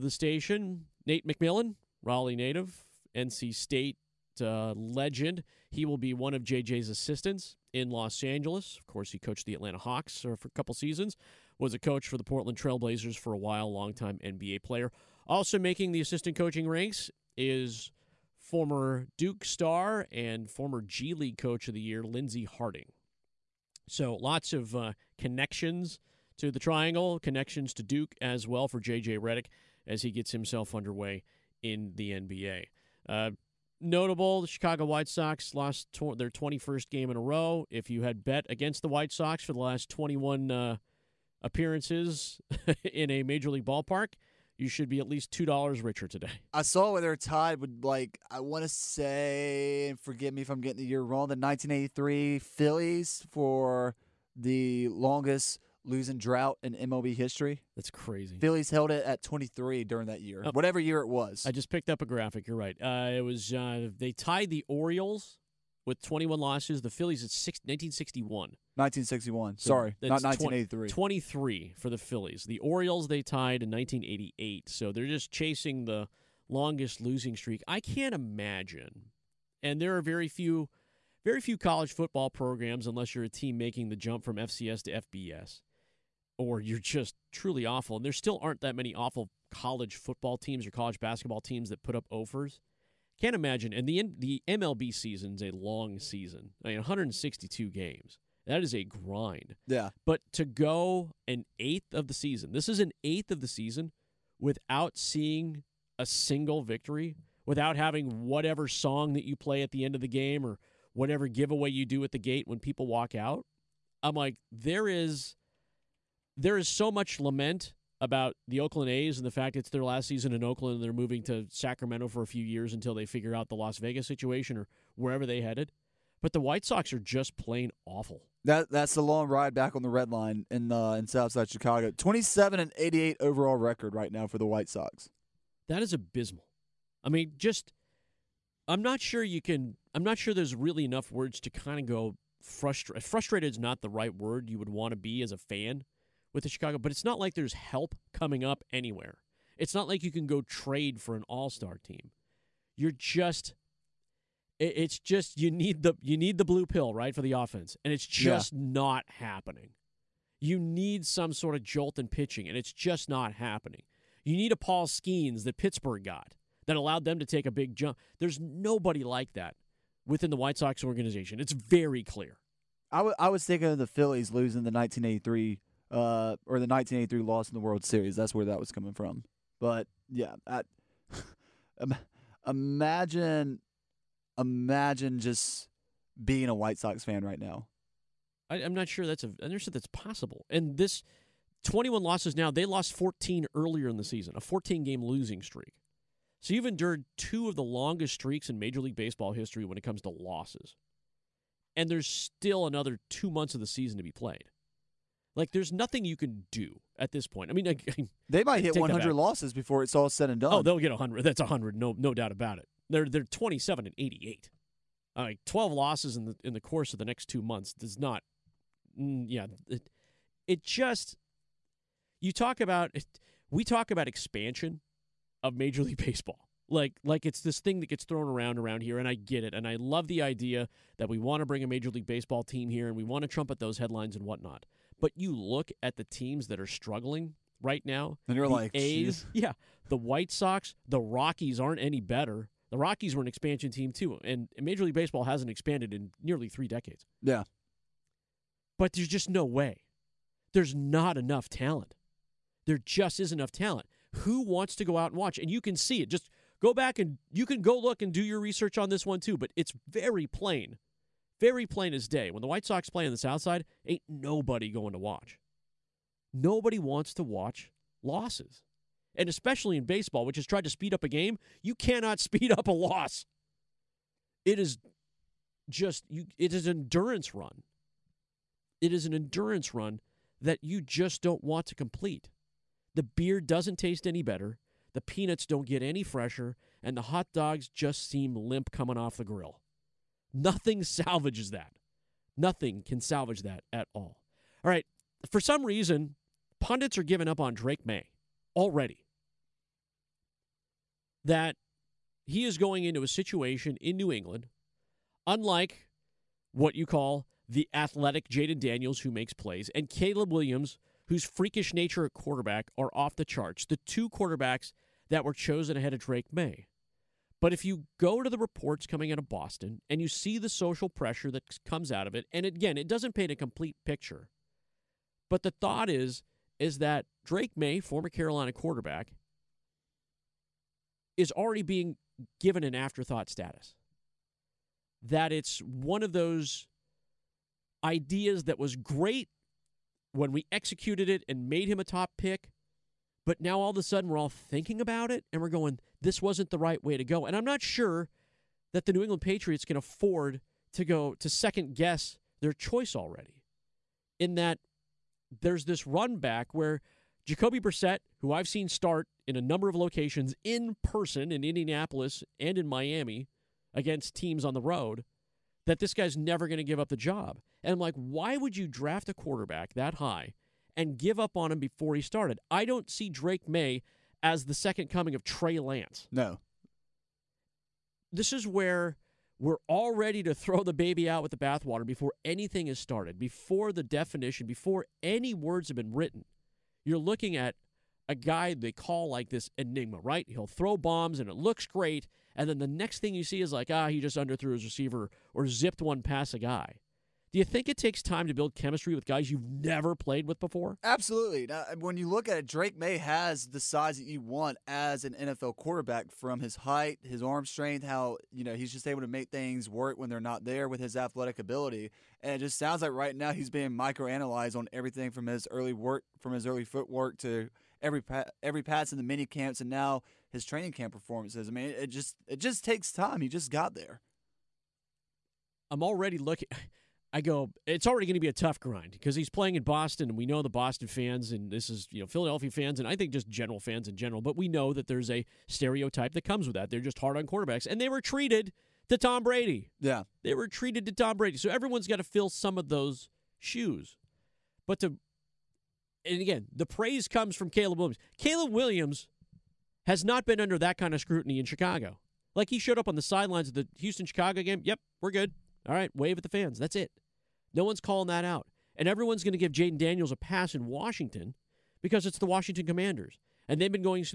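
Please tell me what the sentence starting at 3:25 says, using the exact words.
Like, there's nothing you can do at this point.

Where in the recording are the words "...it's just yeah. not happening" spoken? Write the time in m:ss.
2:37.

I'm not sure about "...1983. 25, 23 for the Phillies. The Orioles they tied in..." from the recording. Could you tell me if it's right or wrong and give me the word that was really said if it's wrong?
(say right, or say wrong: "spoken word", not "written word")
wrong: "20", not "25".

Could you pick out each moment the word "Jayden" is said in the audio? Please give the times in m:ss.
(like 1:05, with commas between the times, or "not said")
5:08, 7:39.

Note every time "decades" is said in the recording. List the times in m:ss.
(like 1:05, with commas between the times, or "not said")
4:06.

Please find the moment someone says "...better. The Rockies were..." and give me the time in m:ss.
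4:02.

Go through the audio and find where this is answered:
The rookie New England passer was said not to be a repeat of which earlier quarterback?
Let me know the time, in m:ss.
6:15.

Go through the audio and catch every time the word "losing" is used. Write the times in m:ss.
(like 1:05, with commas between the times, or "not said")
0:55, 1:17, 2:54, 3:15.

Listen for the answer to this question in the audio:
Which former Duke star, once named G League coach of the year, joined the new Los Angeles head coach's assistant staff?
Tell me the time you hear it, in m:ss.
0:22.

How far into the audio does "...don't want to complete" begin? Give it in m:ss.
4:41.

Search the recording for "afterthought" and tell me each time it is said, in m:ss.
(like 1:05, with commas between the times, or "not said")
5:32.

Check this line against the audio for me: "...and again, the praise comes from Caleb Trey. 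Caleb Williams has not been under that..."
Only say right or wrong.
wrong.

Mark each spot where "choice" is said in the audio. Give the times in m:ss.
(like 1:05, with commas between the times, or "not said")
5:52.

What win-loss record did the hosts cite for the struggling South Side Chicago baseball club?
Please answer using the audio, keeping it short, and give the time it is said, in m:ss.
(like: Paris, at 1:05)
27-88, at 2:11.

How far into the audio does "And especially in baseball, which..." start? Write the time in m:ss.
4:29.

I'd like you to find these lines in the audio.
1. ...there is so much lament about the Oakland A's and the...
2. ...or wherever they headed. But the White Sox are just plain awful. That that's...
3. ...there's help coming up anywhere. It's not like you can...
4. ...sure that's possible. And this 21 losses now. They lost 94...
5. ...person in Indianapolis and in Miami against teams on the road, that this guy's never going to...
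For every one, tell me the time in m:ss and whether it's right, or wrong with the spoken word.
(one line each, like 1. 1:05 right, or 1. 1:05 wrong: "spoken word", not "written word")
1. 1:56 right
2. 2:04 right
3. 2:27 right
4. 3:09 wrong: "14", not "94"
5. 6:00 right.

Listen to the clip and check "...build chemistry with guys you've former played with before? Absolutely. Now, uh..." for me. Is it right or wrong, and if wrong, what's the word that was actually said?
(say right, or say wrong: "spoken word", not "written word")
wrong: "never", not "former".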